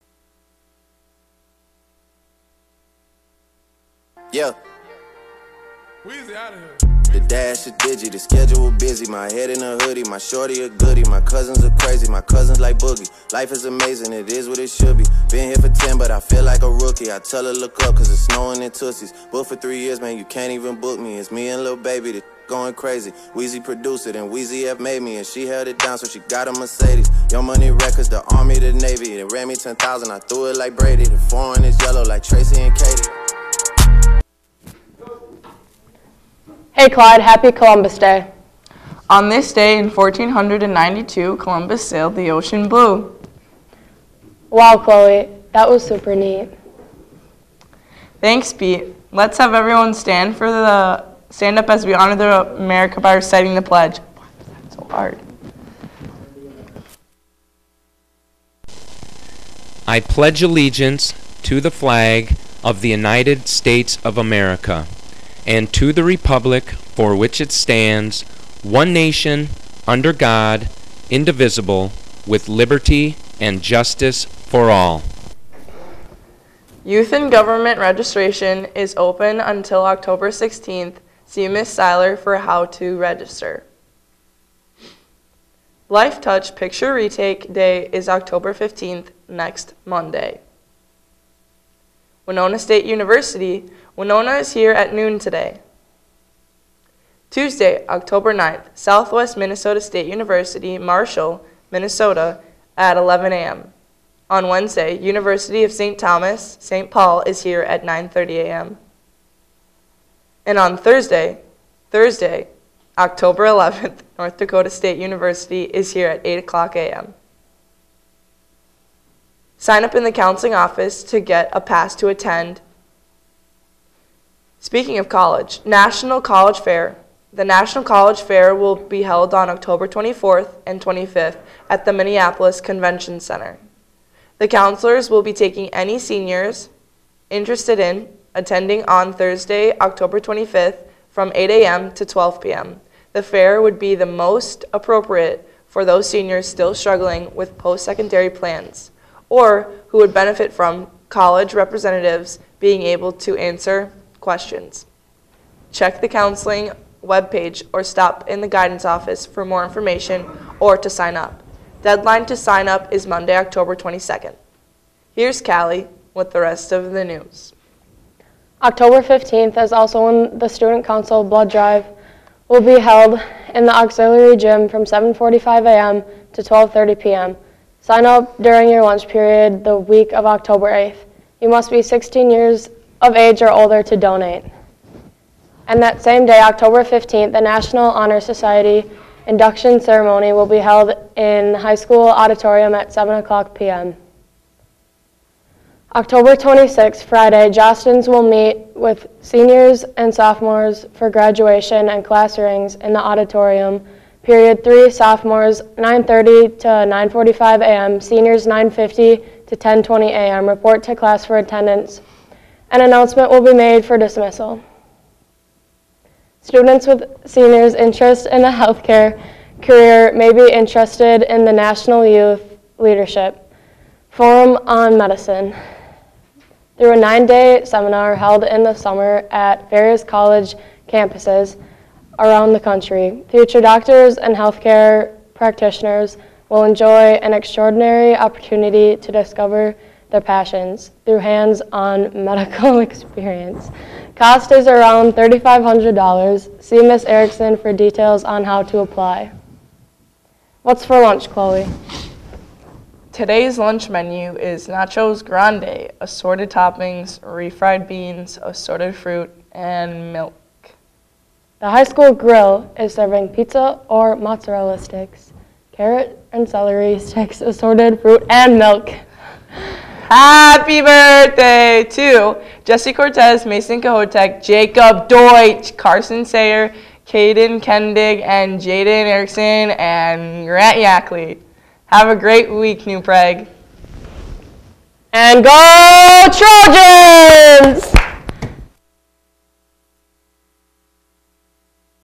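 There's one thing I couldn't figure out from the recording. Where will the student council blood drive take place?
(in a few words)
Auxiliary gym.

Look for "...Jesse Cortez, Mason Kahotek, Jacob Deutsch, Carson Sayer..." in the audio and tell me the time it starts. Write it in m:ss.
4:32.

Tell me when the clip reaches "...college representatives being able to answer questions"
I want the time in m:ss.
2:31.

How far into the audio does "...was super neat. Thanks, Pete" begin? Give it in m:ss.
0:45.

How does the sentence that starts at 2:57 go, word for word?
Sign up during your lunch period the week of October 8th.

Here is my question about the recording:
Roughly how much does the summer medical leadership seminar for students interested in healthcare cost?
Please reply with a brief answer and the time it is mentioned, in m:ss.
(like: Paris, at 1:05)
$3,500, at 4:05.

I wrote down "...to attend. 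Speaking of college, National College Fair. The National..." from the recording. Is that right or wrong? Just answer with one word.
right.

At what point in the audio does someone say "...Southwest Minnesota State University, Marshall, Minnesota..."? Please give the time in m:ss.
1:38.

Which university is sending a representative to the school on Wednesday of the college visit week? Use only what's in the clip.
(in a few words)
University of St. Thomas.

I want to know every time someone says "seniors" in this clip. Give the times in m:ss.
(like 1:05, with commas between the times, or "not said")
2:15, 2:26, 3:19, 3:27, 3:37.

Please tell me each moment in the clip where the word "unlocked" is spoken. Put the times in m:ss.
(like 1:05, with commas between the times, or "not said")
not said.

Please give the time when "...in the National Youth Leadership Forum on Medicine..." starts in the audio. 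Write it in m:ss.
3:41.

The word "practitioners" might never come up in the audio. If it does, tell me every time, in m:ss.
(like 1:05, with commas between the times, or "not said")
3:55.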